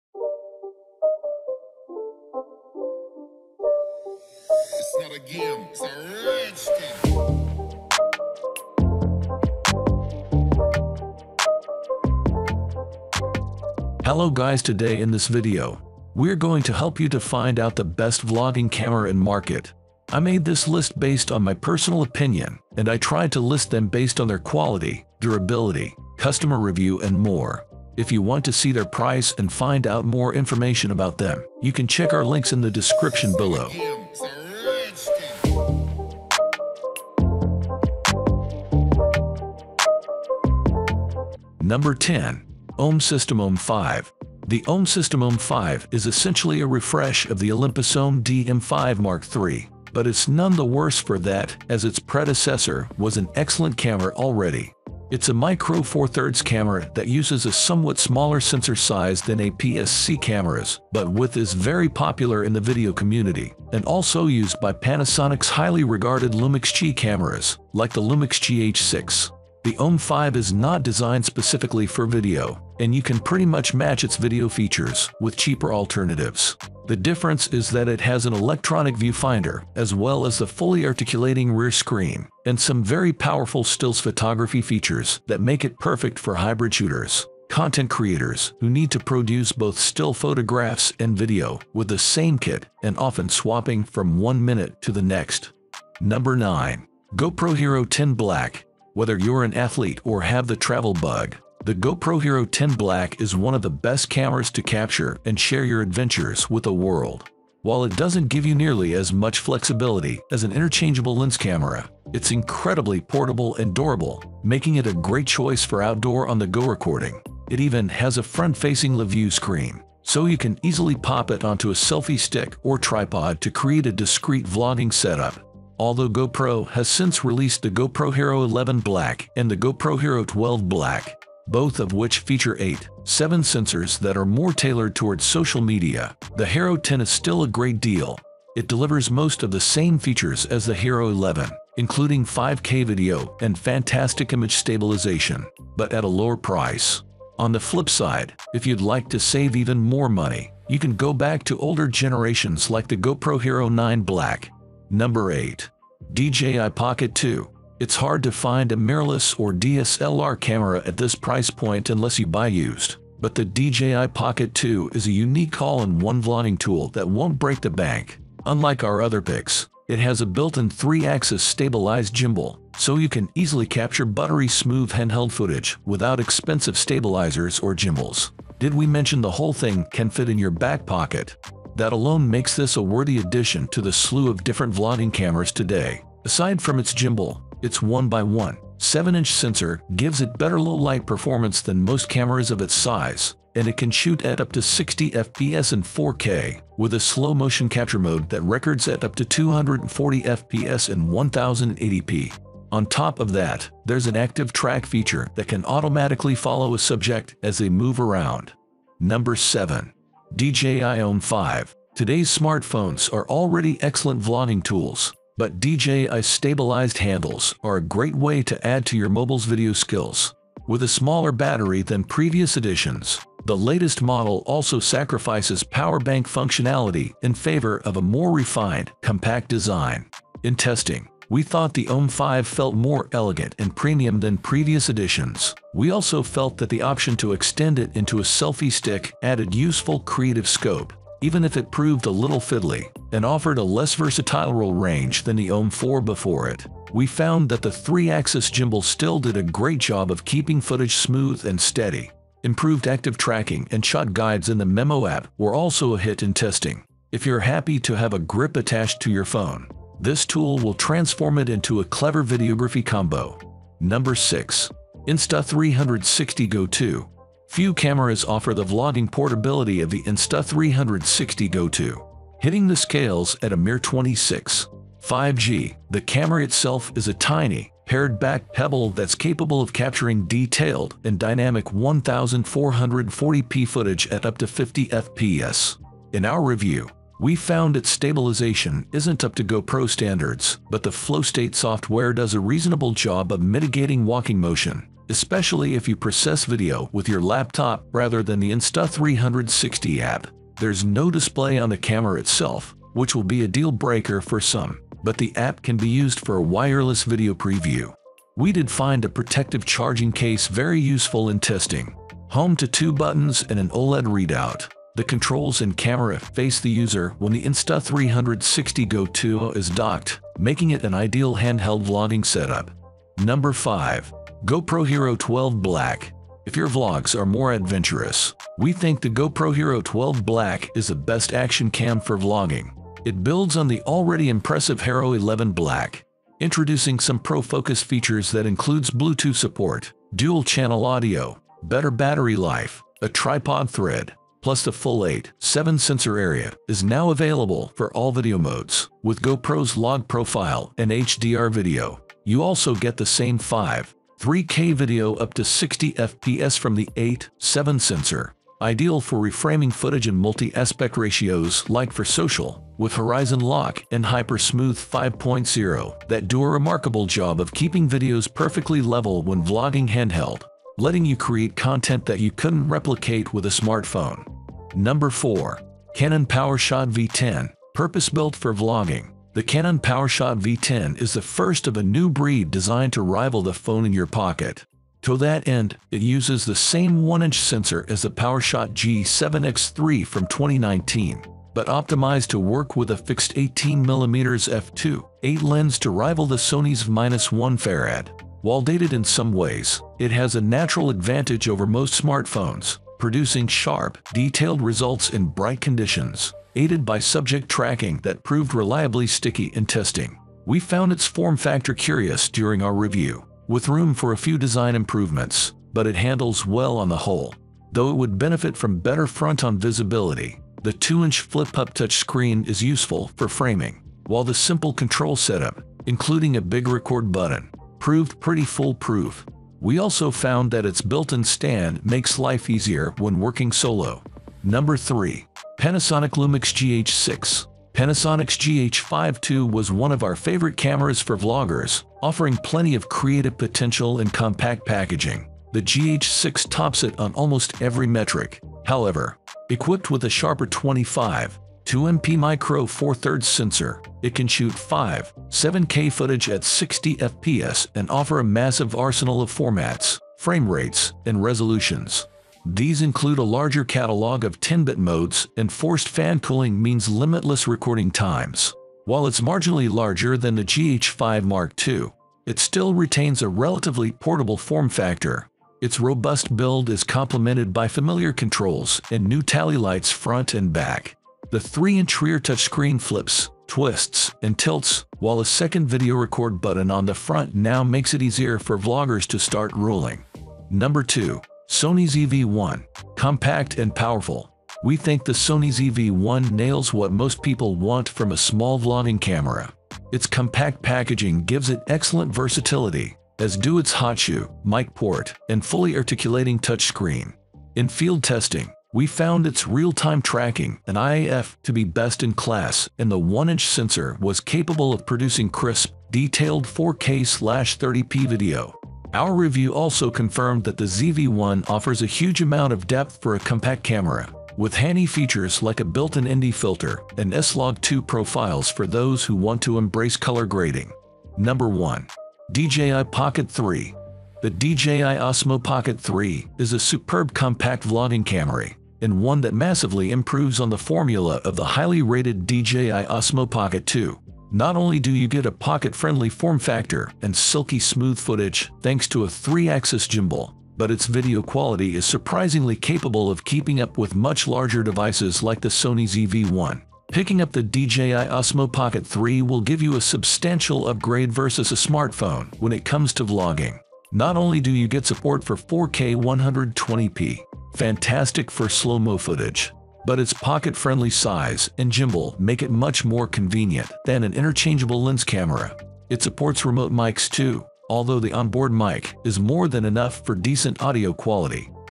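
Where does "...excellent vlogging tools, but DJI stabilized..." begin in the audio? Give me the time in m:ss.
3:33.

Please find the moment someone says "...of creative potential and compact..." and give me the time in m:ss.
7:22.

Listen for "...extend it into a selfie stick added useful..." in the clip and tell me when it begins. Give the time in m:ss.
3:57.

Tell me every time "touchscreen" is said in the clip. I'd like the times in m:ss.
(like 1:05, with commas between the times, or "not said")
7:01, 8:02, 8:26.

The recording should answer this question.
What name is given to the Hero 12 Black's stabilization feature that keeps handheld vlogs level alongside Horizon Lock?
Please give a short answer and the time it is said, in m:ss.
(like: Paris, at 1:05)
HyperSmooth 5.0, at 6:04.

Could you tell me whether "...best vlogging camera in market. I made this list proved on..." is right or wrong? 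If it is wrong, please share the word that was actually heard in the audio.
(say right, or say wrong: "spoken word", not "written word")
wrong: "based", not "proved".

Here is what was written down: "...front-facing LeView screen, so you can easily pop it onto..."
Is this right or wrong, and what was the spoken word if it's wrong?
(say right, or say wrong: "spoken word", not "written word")
right.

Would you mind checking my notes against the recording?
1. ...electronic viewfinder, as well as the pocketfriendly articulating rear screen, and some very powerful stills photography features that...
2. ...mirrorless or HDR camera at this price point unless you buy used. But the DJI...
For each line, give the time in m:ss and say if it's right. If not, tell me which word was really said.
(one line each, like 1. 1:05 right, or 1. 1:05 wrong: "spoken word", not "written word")
1. 1:18 wrong: "fully", not "pocketfriendly"
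2. 2:38 wrong: "DSLR", not "HDR".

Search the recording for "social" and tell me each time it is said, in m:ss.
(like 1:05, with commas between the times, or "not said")
2:15, 6:02.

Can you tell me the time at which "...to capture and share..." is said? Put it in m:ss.
1:44.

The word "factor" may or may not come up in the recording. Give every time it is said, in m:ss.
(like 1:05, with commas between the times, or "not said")
6:51, 7:54, 9:06.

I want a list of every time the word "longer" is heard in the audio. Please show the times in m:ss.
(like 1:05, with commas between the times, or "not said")
not said.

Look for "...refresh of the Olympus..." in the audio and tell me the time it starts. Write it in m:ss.
0:46.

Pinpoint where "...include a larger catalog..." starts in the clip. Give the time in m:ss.
7:42.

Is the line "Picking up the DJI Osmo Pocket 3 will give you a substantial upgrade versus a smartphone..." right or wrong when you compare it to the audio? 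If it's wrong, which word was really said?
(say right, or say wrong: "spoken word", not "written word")
right.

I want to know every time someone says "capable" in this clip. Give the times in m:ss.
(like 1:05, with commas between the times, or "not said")
4:39, 8:34, 9:12.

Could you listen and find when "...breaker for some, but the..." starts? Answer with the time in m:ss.
5:03.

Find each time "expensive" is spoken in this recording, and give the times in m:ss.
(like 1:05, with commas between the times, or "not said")
2:56.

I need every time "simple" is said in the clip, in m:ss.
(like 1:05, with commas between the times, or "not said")
7:04.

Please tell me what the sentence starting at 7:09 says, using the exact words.
We also found that its built-in stand makes life easier when working solo.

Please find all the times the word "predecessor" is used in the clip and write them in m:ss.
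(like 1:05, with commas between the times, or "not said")
0:51.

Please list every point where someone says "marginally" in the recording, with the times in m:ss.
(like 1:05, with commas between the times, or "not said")
7:49.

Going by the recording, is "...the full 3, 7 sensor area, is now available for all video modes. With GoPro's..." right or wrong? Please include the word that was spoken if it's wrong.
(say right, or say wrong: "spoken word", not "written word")
wrong: "8", not "3".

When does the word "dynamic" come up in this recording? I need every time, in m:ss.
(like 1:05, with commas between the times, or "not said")
4:41.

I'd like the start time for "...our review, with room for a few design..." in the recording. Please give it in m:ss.
6:52.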